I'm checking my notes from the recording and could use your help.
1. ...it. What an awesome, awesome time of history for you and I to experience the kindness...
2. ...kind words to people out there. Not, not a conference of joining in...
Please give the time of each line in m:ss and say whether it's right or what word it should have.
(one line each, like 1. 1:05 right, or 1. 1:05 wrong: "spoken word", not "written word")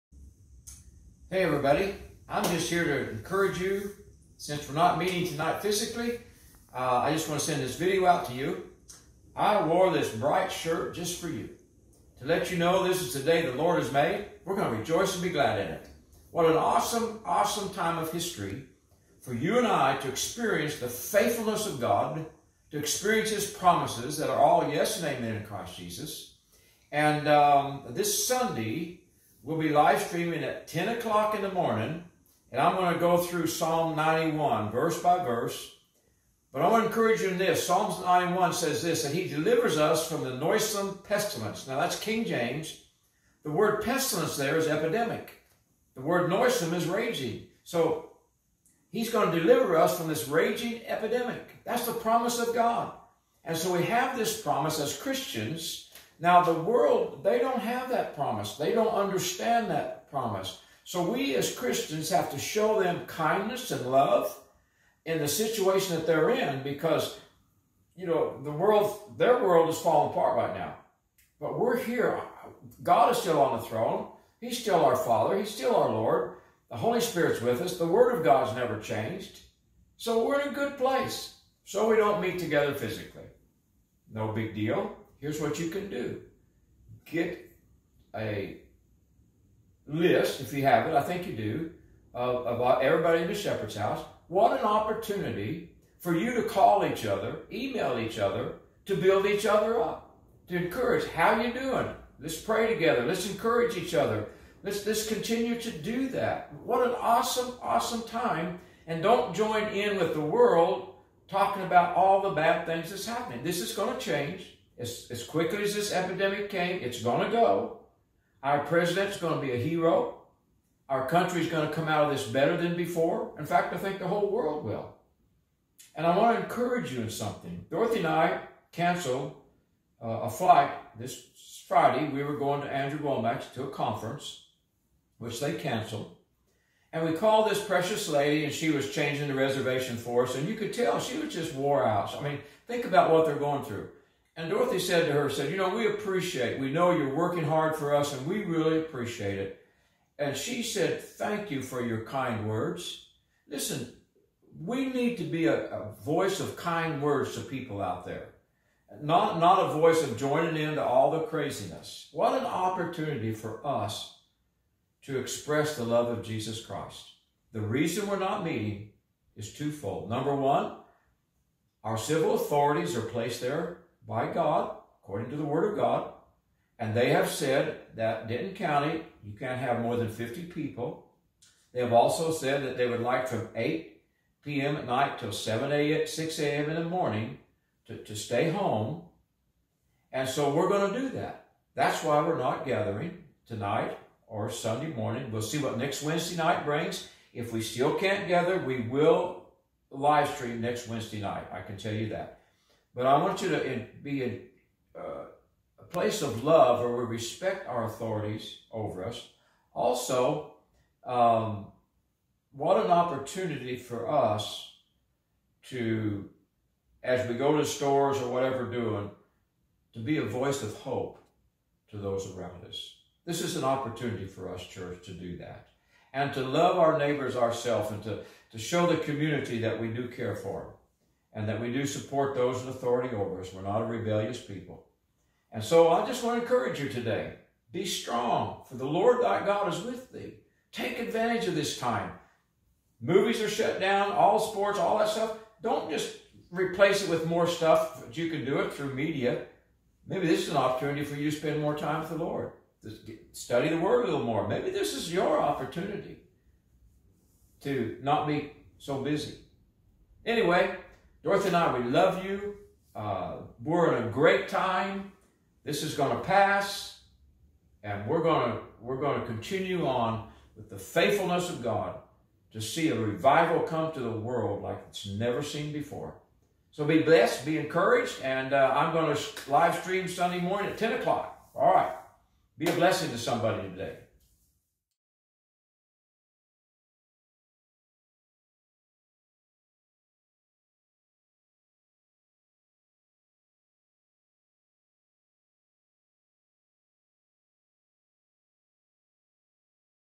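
1. 0:15 wrong: "faithfulness", not "kindness"
2. 2:36 wrong: "voice", not "conference".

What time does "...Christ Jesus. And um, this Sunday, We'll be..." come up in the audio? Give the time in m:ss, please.
0:25.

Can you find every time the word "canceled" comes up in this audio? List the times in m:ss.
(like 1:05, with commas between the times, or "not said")
2:08, 2:15.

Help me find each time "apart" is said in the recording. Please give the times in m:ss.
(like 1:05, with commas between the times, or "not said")
1:10.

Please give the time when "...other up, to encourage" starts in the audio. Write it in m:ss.
1:39.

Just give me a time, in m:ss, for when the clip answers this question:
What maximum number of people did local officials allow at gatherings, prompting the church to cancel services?
3:00.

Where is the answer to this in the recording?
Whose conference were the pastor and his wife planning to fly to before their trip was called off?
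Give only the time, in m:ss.
2:12.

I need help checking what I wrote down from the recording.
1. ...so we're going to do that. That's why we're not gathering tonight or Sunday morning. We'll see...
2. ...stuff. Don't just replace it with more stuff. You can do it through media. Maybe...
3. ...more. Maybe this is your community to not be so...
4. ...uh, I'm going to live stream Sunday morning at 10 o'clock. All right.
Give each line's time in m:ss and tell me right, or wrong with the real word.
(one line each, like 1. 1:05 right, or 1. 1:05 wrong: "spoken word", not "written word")
1. 3:10 right
2. 4:05 right
3. 4:14 wrong: "opportunity", not "community"
4. 4:38 right.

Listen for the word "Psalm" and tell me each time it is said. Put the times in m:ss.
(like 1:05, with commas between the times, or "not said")
0:33, 0:37.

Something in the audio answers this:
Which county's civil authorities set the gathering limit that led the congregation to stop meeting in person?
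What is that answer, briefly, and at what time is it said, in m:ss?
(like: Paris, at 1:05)
Denton County, at 2:58.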